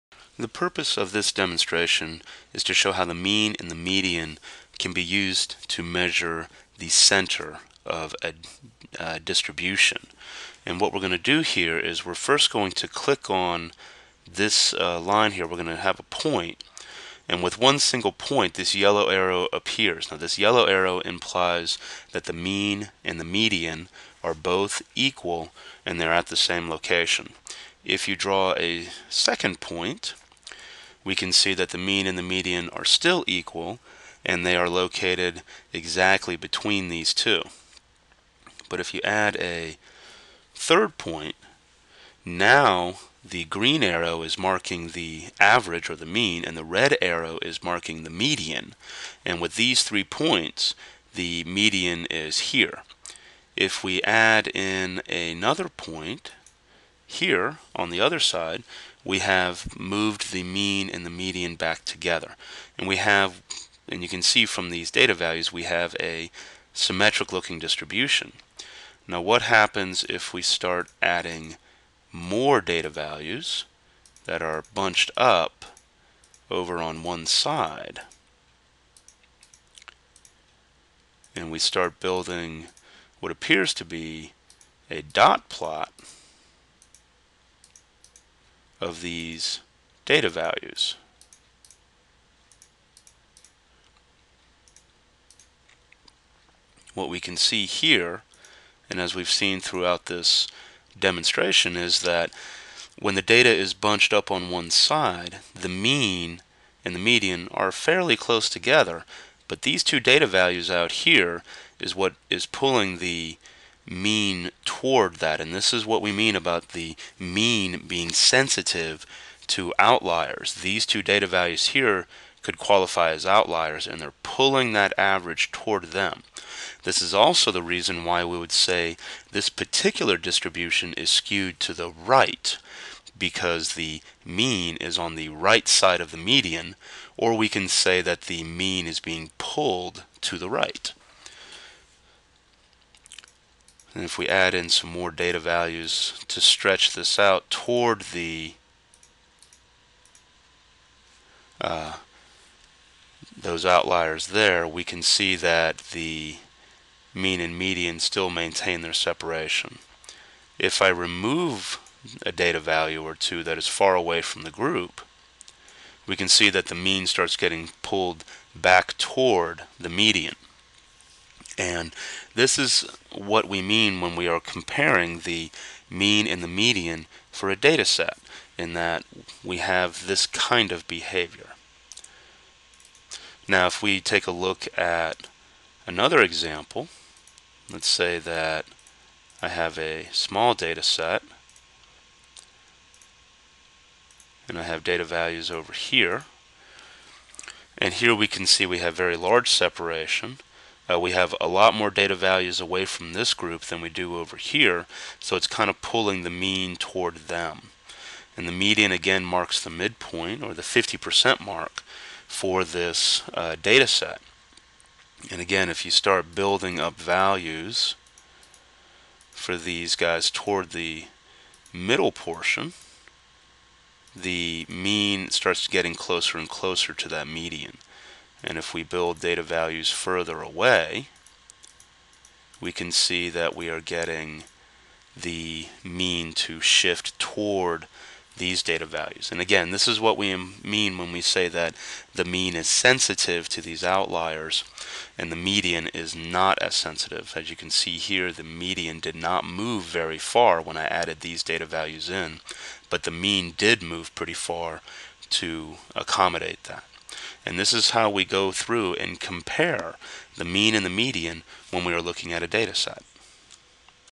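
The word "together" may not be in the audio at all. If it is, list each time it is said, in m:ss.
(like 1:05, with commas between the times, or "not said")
1:01, 1:48.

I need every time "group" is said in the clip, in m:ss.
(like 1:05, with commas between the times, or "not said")
2:44, 3:23.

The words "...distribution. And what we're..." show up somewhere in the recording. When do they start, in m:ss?
0:09.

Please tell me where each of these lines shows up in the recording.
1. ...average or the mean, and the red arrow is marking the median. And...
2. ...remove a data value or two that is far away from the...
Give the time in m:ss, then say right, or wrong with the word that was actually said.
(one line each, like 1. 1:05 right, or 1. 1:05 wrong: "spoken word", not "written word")
1. 0:45 right
2. 2:40 right.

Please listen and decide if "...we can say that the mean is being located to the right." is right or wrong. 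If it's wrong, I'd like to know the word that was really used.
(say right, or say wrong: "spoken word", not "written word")
wrong: "pulled", not "located".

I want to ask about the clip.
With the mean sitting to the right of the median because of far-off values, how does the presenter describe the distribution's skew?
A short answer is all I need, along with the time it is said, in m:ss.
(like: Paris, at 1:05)
Skewed to the right, at 2:11.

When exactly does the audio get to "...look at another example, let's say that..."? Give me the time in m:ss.
3:04.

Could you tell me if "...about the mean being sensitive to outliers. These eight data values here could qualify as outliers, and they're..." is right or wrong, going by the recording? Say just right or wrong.
wrong.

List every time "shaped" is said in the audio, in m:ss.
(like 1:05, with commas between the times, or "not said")
not said.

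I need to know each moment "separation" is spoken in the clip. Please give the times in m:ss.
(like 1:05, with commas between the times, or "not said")
2:38, 3:19.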